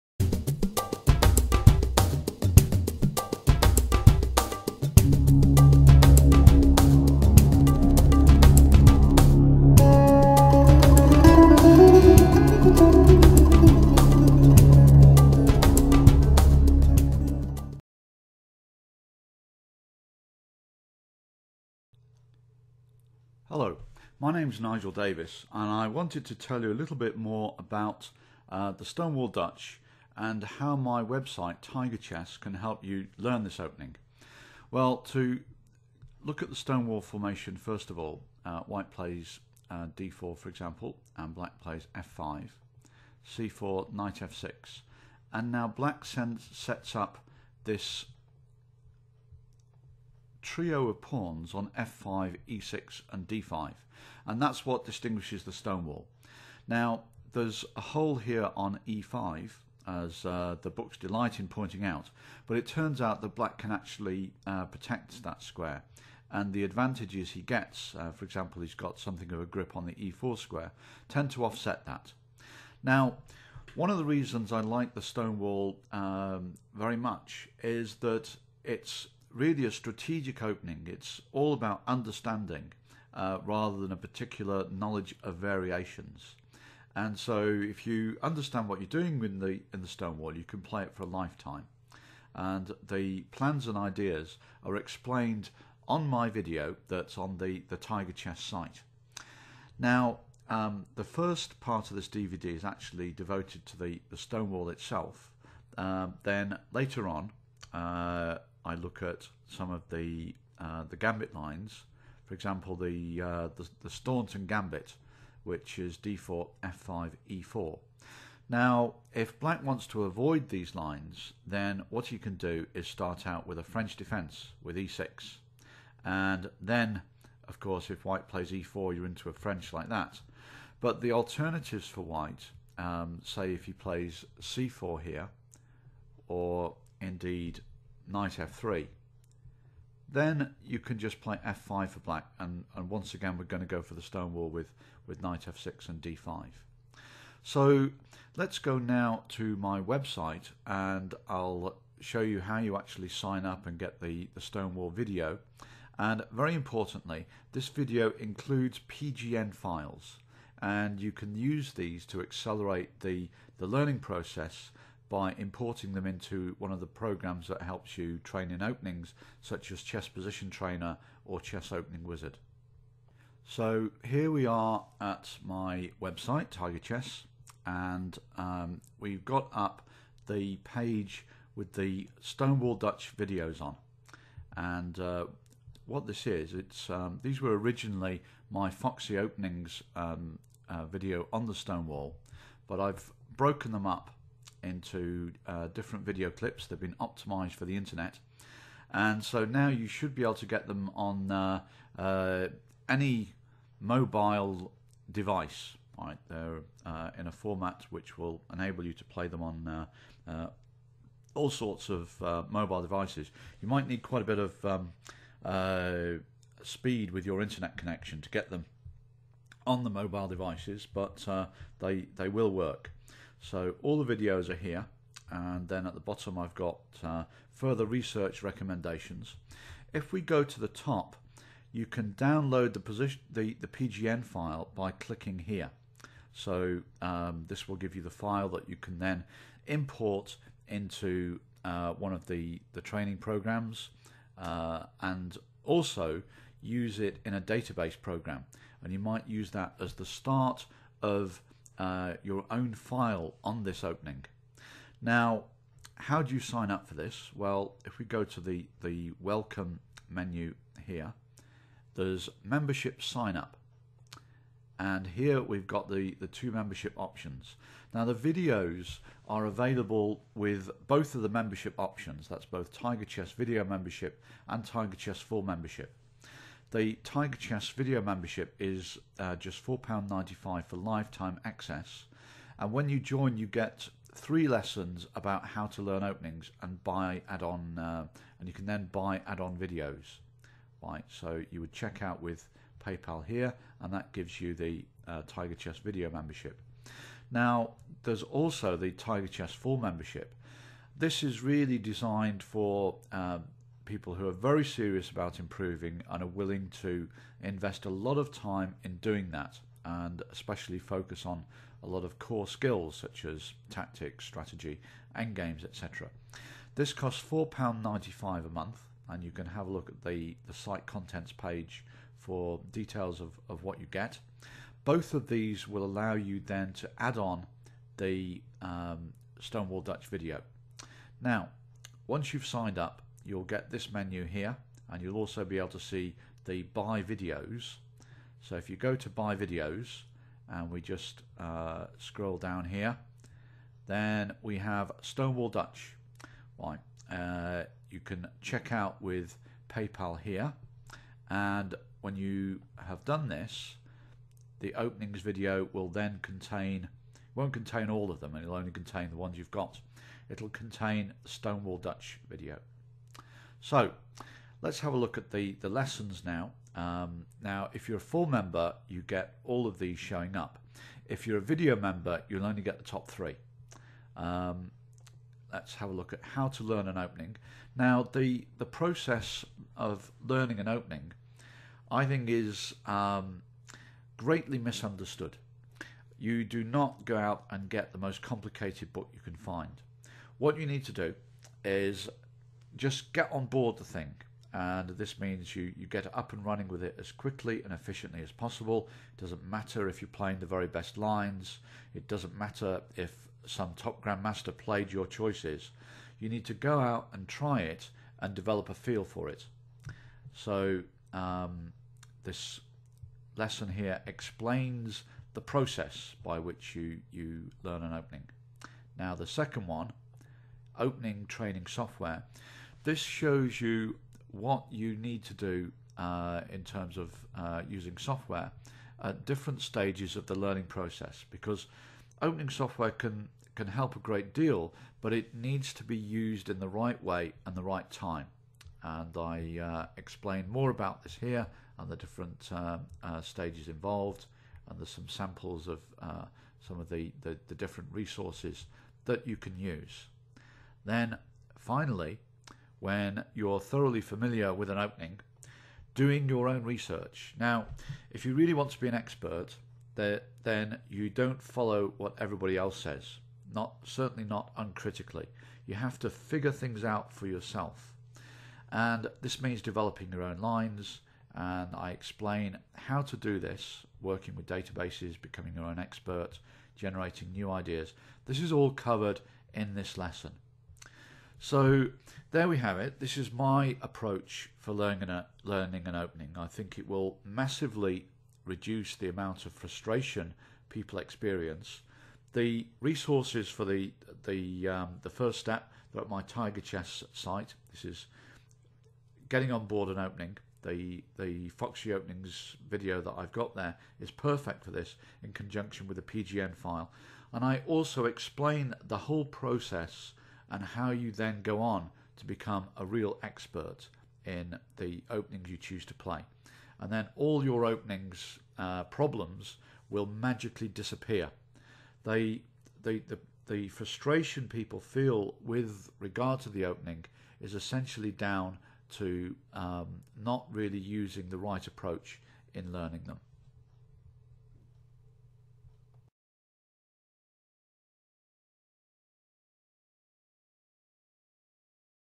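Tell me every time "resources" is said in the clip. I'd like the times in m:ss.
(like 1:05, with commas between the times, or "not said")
7:27, 8:12.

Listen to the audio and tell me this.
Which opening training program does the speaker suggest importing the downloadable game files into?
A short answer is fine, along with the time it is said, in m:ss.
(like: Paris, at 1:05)
Chess Position Trainer, at 2:49.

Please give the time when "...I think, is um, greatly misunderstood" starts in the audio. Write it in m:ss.
6:21.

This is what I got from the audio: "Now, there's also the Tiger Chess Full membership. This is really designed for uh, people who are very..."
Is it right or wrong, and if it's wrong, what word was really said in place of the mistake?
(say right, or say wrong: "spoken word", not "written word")
right.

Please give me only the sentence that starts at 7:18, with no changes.
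And I uh, explain more about this here and the different uh, uh, stages involved.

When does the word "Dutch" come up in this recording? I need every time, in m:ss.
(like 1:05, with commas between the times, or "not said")
0:29, 3:02, 5:29, 5:45, 6:01.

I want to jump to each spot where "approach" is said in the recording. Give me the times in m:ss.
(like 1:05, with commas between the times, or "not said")
8:03, 8:51.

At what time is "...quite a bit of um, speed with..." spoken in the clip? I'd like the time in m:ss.
3:34.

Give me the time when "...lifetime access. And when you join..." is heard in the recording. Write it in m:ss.
4:40.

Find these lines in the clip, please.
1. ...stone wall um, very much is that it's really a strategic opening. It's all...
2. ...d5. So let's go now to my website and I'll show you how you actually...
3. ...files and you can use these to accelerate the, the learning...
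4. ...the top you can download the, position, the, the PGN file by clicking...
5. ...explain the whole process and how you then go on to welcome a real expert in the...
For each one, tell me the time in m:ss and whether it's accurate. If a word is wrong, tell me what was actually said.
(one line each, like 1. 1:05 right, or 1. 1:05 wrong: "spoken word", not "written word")
1. 1:15 right
2. 2:26 right
3. 2:39 right
4. 3:50 right
5. 8:28 wrong: "become", not "welcome".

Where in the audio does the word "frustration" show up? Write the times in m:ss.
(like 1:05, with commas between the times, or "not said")
8:09, 8:43.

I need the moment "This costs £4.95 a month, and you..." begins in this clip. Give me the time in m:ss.
5:16.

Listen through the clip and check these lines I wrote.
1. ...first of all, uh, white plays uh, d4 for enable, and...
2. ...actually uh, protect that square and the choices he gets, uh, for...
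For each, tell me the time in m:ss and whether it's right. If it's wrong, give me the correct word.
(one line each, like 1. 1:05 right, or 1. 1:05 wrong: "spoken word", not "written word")
1. 0:37 wrong: "example", not "enable"
2. 1:03 wrong: "advantages", not "choices".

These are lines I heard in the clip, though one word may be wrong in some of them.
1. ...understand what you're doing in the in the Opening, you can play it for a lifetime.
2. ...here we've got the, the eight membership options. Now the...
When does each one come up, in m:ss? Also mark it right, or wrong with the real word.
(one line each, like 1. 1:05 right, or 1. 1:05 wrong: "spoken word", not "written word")
1. 1:28 wrong: "Stonewall", not "Opening"
2. 4:25 wrong: "two", not "eight".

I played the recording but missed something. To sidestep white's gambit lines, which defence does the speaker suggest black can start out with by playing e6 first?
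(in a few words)
French defense.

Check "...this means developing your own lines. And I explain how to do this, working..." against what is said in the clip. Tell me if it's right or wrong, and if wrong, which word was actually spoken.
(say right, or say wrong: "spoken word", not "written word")
right.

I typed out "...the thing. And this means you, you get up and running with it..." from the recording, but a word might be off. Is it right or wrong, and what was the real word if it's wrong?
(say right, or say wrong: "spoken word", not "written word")
right.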